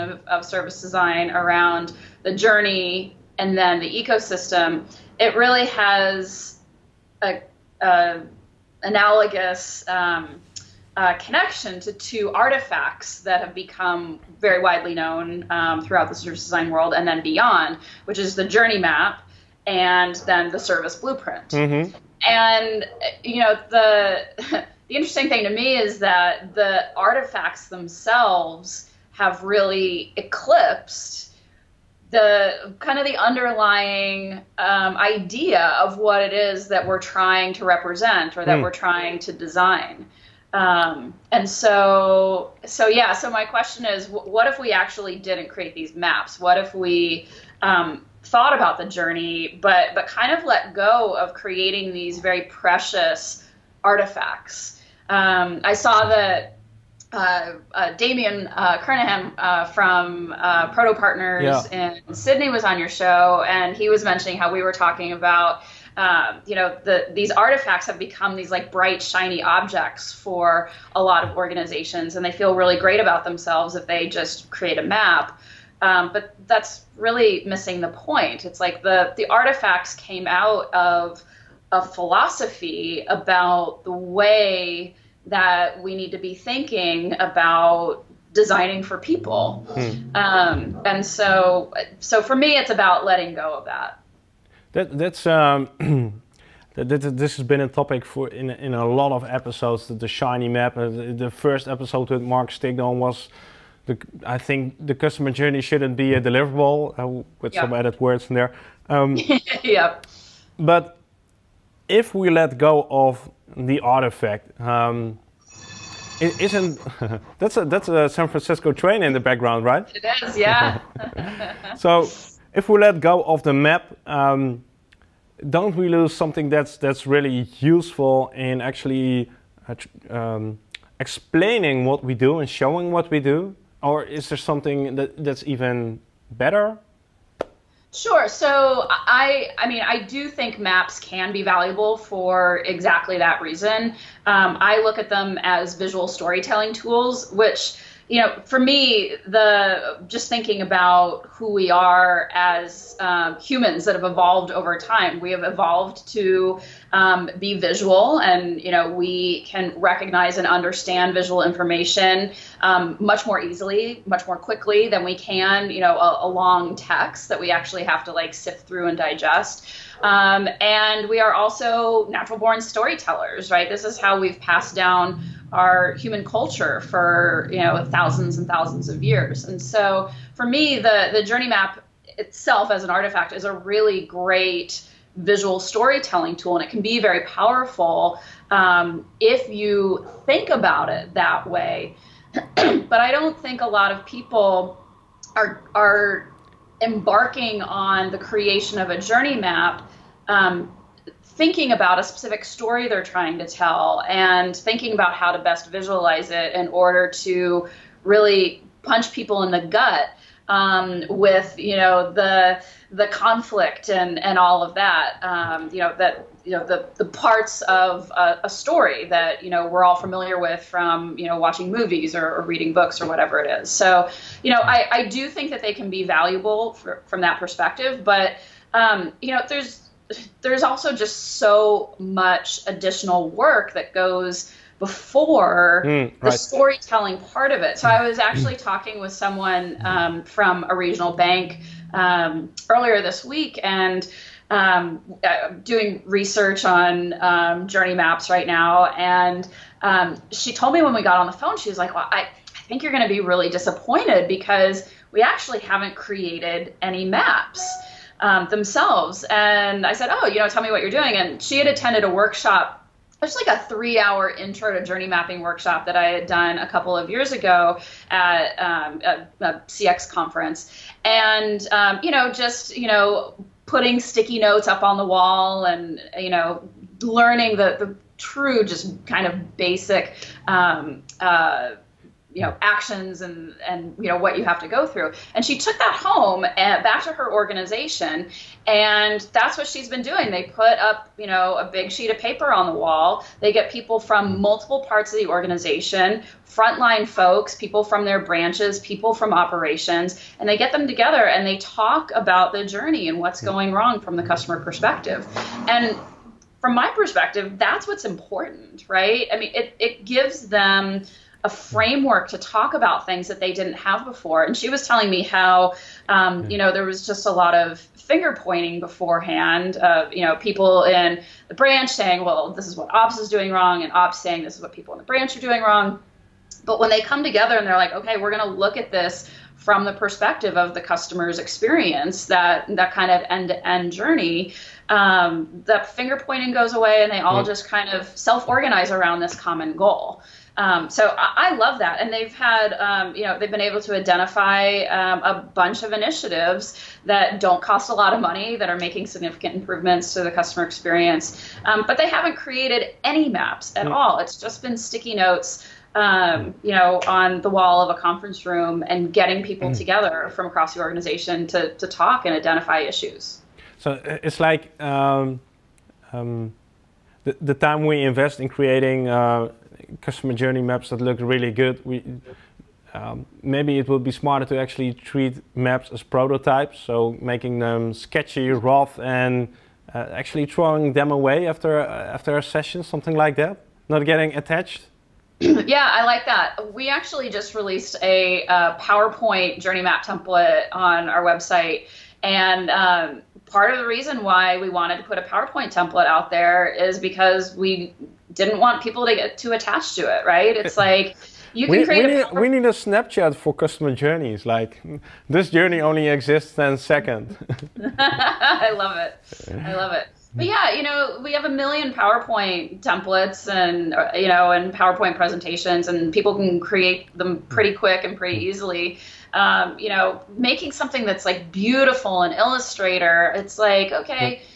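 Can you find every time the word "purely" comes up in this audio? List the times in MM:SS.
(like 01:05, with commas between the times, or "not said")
not said.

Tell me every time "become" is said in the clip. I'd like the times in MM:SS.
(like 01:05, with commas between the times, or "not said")
00:13, 01:07.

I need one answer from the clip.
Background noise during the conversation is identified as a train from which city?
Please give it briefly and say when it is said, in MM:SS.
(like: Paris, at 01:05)
San Francisco, at 01:58.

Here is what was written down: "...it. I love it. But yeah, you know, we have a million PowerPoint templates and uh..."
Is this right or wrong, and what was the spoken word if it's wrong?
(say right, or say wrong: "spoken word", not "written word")
right.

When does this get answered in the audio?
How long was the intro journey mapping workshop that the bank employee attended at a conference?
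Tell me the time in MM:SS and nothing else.
04:23.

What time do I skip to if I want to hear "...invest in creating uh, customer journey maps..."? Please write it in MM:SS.
06:08.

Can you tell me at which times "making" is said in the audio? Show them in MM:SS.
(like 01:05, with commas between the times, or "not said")
05:48, 06:17, 07:00.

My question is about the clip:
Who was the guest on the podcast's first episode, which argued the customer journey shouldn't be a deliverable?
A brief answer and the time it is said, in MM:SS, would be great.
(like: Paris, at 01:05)
Mark Stigdon, at 01:42.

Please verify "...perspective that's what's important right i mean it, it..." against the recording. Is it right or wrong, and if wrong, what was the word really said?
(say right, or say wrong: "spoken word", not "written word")
right.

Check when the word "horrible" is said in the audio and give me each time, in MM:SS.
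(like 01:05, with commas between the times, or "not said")
not said.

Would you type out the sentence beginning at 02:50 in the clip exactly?
Um, and we are also natural born storytellers, right?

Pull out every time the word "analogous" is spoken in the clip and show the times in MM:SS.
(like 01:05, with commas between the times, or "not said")
00:08.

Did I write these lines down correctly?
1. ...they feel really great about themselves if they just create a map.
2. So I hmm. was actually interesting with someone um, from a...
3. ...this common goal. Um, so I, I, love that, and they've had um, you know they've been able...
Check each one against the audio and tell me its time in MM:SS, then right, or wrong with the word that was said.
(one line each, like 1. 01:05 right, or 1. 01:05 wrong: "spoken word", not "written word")
1. 01:12 right
2. 03:57 wrong: "talking", not "interesting"
3. 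05:39 right.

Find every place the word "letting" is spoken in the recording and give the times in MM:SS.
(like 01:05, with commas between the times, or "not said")
01:33.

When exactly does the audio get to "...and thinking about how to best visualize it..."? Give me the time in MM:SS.
03:24.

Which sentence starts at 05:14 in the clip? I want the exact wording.
And she was telling me how, um, you know, there was just a lot of finger pointing beforehand.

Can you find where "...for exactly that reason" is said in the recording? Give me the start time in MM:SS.
02:21.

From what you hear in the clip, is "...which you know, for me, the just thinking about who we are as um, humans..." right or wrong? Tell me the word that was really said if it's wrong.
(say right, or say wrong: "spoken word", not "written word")
right.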